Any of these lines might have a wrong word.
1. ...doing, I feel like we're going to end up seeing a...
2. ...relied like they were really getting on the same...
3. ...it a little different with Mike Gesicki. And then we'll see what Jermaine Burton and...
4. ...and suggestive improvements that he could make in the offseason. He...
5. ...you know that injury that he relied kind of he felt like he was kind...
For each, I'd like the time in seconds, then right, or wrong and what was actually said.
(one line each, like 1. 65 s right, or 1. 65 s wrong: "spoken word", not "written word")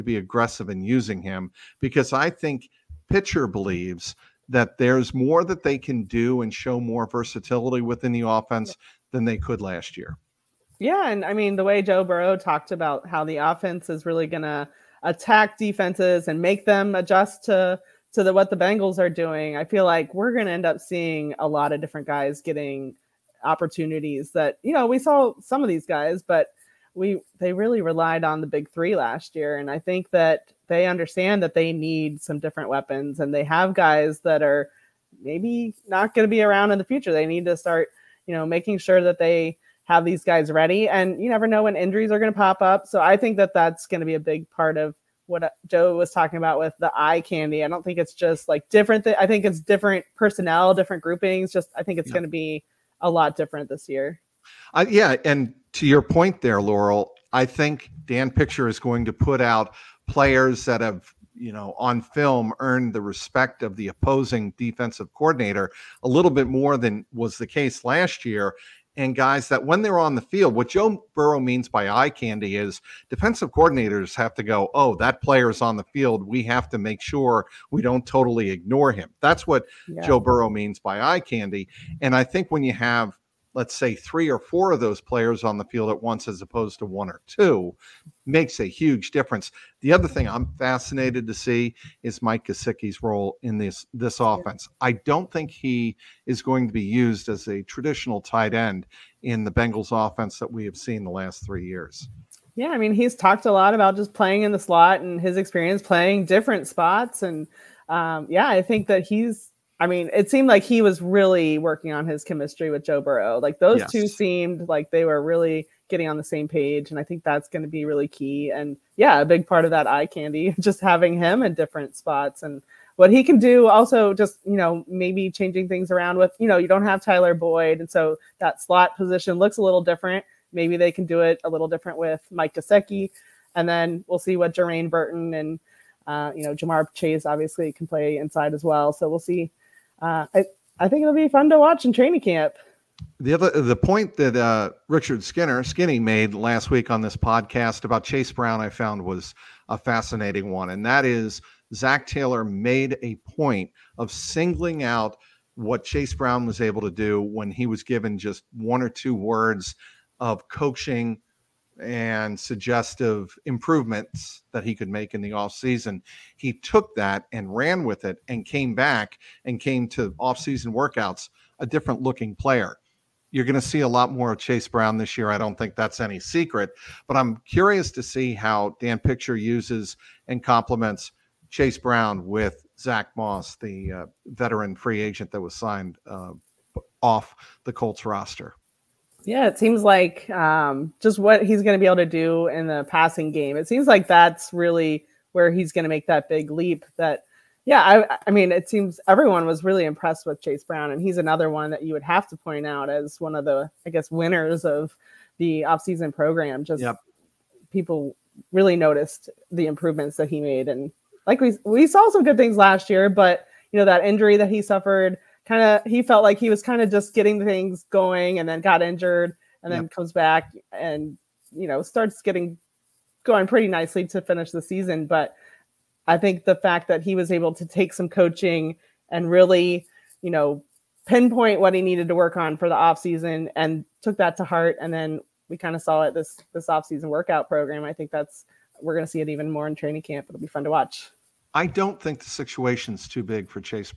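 1. 19 s right
2. 114 s wrong: "seemed", not "relied"
3. 131 s right
4. 161 s right
5. 213 s wrong: "suffered", not "relied".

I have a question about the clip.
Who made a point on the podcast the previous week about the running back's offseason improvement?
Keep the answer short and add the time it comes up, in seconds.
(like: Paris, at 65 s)
Richard Skinner, at 144 s.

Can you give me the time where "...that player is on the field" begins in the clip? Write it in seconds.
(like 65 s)
74 s.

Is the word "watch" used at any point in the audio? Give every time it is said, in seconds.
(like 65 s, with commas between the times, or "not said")
141 s, 240 s.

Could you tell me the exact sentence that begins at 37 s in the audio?
They need to start, you know, making sure that they have these guys ready.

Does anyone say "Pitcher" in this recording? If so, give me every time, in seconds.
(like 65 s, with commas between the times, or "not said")
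3 s, 58 s, 178 s.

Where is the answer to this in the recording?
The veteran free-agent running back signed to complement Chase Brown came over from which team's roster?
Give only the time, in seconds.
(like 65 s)
187 s.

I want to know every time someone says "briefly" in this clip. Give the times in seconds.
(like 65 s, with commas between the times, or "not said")
not said.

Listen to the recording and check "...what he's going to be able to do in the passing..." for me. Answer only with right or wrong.
right.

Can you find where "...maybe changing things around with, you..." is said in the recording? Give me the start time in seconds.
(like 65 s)
124 s.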